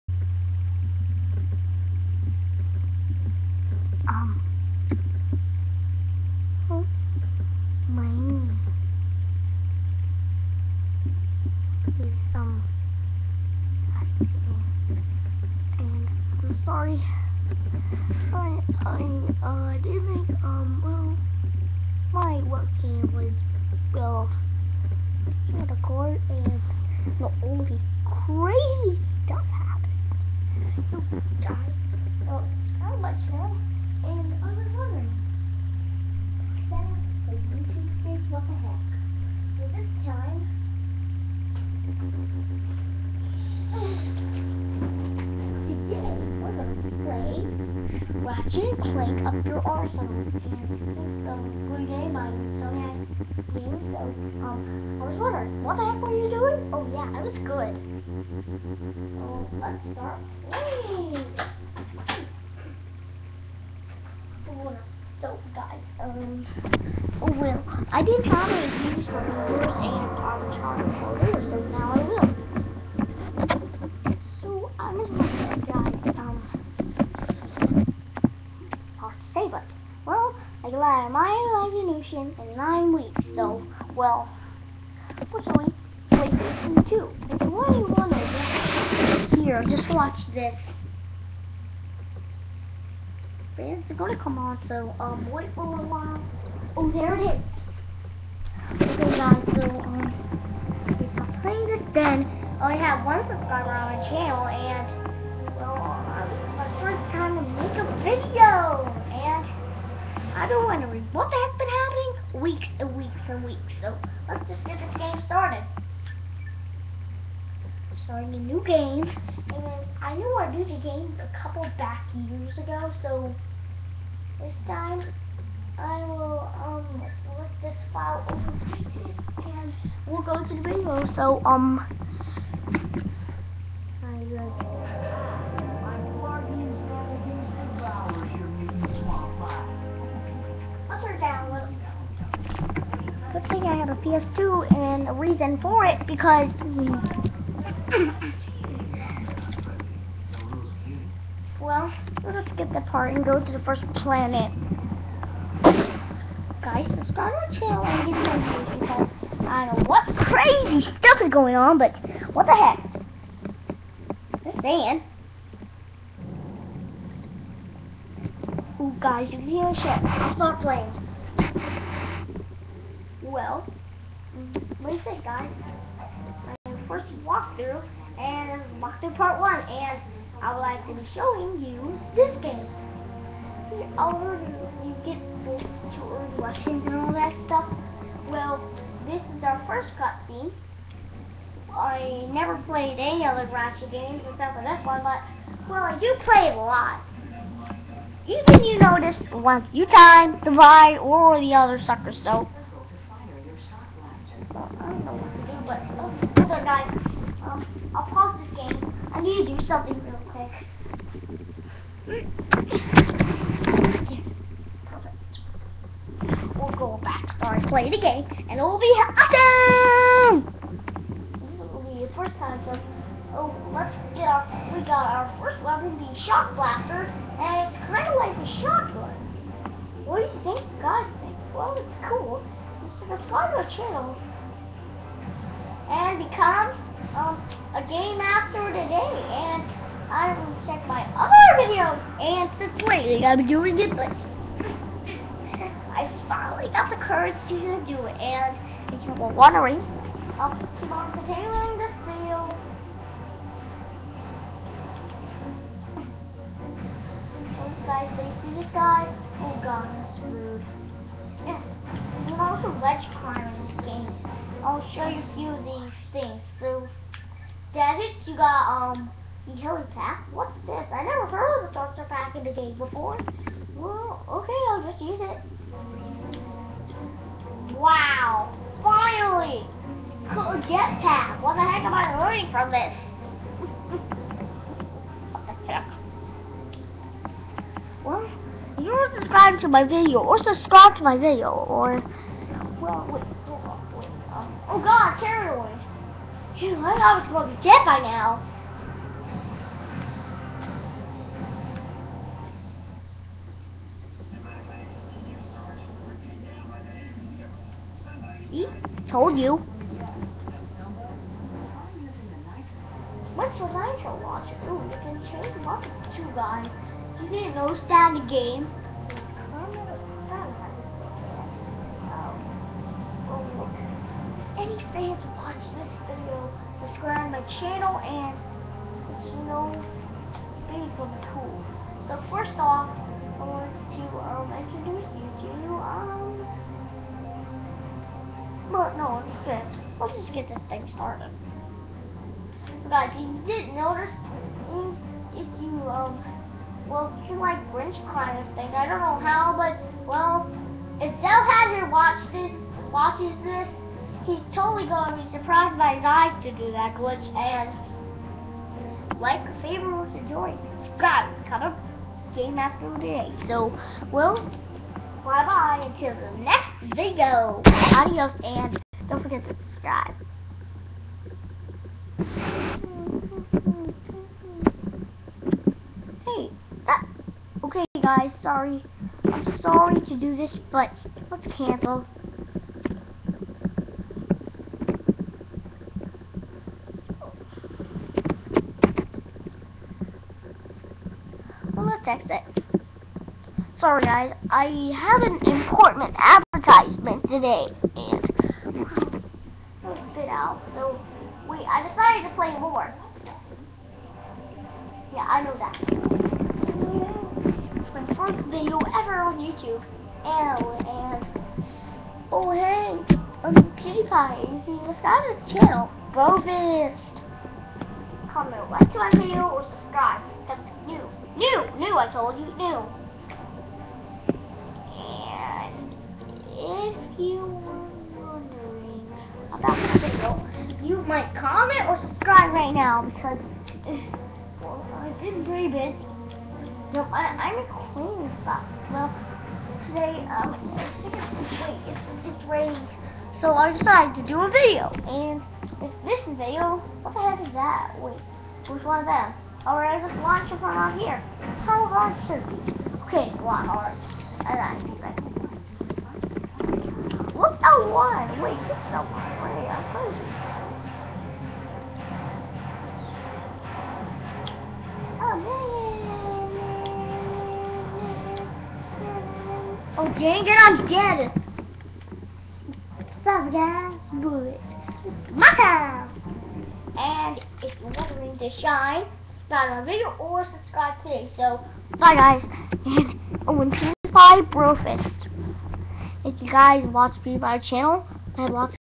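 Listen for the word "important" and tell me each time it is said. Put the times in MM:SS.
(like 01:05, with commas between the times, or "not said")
06:35.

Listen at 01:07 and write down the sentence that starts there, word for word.
I didn't normally use what you were saying on the chart so now I will.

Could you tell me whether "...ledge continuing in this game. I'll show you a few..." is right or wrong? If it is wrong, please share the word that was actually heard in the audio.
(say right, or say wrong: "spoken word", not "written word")
wrong: "climbing", not "continuing".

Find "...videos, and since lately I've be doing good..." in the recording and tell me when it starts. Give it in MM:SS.
04:01.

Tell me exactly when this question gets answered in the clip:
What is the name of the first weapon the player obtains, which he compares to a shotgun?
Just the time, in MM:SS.
03:46.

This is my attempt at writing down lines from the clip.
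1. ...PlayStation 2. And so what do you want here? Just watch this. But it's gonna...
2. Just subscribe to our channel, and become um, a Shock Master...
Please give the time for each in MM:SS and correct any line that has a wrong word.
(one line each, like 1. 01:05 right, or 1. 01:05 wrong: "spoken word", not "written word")
1. 01:26 right
2. 03:52 wrong: "Game", not "Shock".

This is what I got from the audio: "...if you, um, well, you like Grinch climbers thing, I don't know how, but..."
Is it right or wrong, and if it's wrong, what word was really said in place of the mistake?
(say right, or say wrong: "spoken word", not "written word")
right.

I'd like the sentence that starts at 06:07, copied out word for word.
Adios, and don't forget to subscribe.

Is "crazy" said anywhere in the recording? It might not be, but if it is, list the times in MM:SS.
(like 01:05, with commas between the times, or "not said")
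00:28, 02:40, 07:39.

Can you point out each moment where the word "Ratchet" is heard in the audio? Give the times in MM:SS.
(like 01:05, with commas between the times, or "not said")
00:48, 03:13.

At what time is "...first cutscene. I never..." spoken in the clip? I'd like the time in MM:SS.
03:09.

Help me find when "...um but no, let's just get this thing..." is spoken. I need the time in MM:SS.
05:35.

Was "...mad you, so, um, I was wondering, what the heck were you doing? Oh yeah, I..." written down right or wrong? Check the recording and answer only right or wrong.
right.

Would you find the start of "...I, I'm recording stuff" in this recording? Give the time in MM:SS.
07:17.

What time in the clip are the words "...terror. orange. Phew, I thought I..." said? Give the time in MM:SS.
04:55.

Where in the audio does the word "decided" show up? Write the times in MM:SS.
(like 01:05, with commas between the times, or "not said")
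06:41, 07:23.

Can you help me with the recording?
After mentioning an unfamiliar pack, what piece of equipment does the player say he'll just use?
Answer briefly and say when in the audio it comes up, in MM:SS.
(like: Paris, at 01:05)
Jetpack, at 04:40.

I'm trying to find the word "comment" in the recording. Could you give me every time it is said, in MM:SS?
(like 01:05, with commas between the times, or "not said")
06:01, 06:58, 07:11.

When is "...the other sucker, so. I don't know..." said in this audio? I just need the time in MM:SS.
03:21.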